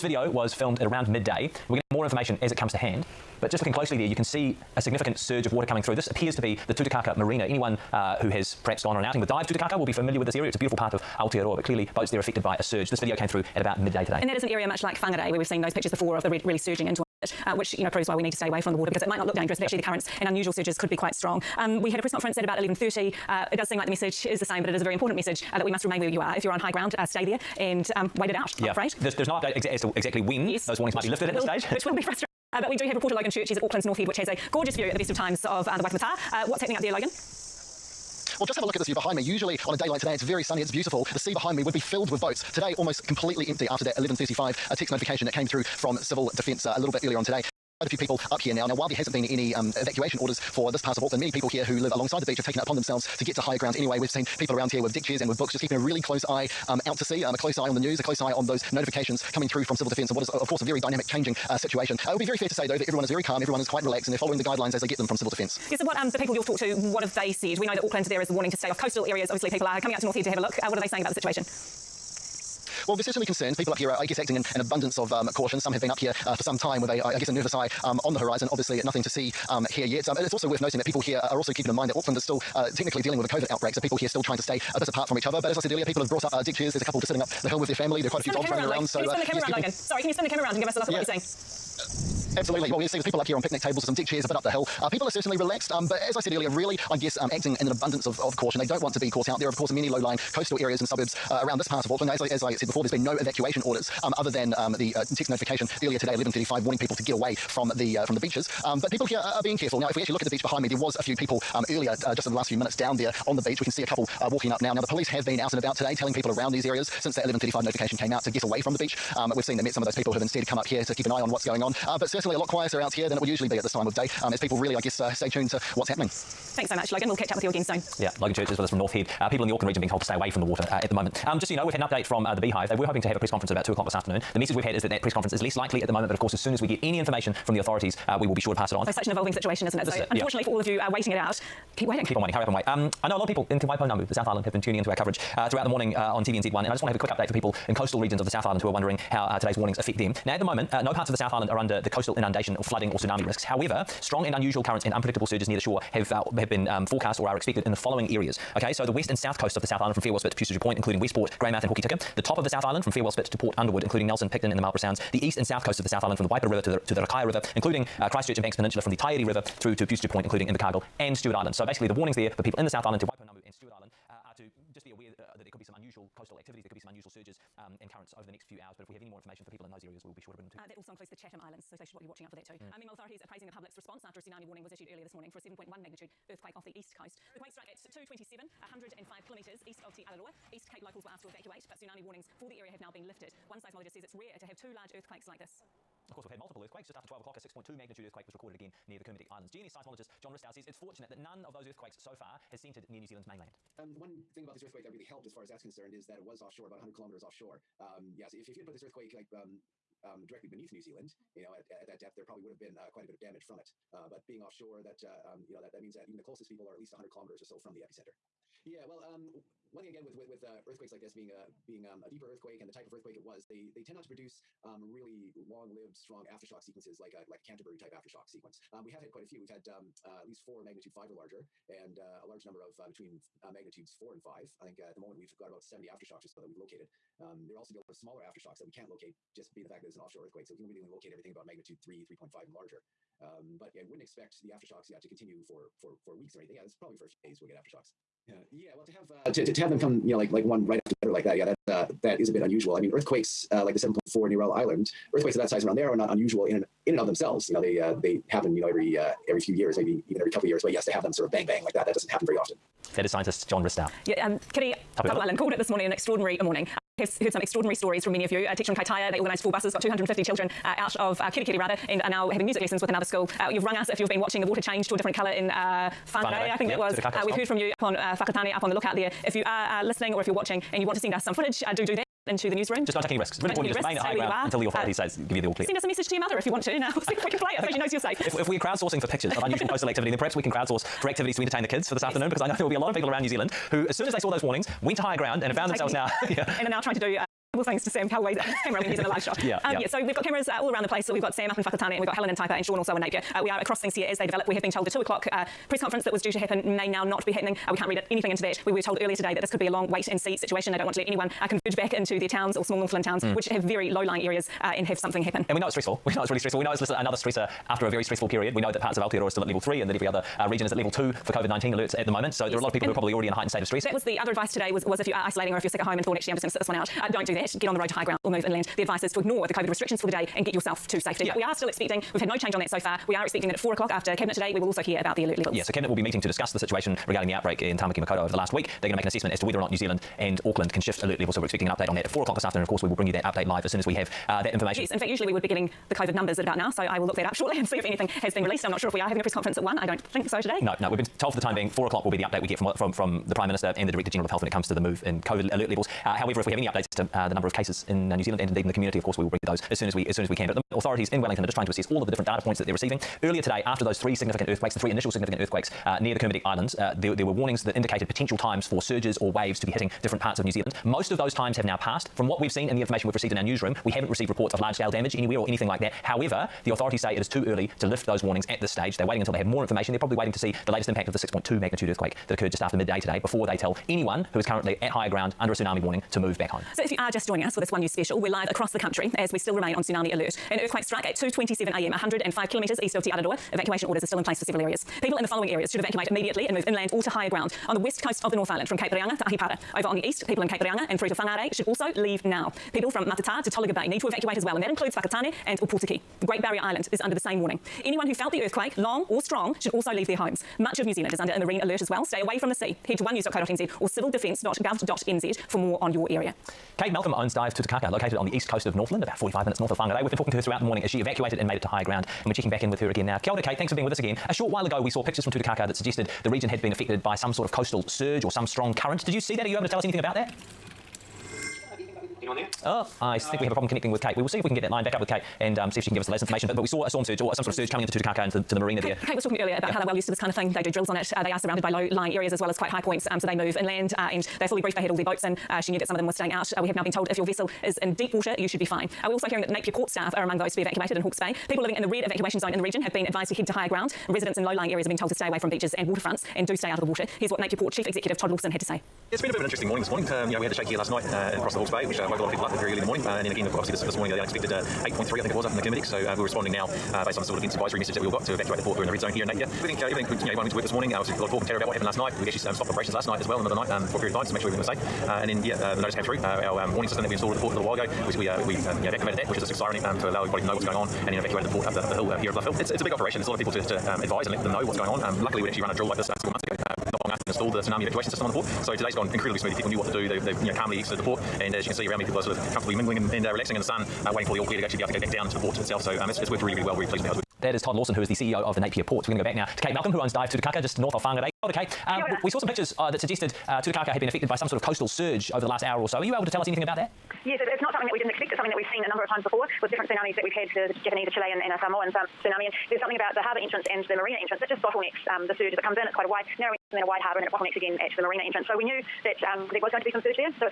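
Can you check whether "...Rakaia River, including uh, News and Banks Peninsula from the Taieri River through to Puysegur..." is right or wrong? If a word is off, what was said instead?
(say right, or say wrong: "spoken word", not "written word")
wrong: "Christchurch", not "News".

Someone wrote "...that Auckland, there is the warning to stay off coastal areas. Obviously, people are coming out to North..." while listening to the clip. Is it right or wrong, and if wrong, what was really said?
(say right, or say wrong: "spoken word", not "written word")
right.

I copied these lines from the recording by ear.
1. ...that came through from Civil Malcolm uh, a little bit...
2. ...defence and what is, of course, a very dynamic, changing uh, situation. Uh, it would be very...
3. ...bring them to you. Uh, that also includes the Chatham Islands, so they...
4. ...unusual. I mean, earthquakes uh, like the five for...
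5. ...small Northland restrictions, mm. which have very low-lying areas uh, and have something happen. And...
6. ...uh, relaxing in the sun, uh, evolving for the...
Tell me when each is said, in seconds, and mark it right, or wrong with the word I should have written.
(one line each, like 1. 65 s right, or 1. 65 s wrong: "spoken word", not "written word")
1. 45 s wrong: "Defence", not "Malcolm"
2. 59 s right
3. 180 s right
4. 252 s wrong: "seven", not "five"
5. 312 s wrong: "towns", not "restrictions"
6. 493 s wrong: "waiting", not "evolving".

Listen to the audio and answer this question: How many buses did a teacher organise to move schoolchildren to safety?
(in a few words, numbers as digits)
4.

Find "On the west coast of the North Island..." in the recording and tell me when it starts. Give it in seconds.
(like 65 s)
397 s.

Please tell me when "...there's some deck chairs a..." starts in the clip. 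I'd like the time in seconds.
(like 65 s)
93 s.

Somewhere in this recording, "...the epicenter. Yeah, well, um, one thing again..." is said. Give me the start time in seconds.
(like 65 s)
217 s.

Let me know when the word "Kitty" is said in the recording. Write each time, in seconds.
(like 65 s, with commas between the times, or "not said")
264 s.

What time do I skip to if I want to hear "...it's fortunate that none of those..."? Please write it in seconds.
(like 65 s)
200 s.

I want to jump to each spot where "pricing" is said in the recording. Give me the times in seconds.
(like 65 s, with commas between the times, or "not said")
not said.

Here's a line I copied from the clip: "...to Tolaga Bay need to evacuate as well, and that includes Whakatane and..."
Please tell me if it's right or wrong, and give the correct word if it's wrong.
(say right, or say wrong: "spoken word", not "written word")
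right.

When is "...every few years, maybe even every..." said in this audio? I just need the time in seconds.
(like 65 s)
259 s.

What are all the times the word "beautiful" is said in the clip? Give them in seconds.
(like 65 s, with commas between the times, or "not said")
10 s, 40 s.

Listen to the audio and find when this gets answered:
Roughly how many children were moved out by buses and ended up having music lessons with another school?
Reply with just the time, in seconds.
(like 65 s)
269 s.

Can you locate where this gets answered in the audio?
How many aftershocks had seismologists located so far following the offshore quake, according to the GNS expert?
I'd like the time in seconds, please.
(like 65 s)
235 s.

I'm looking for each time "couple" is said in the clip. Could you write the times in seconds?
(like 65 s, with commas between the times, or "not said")
86 s, 113 s, 260 s.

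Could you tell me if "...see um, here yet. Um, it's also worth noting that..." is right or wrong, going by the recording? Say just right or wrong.
right.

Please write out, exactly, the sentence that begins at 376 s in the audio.
However, the authorities say it is too early to lift those warnings at this stage.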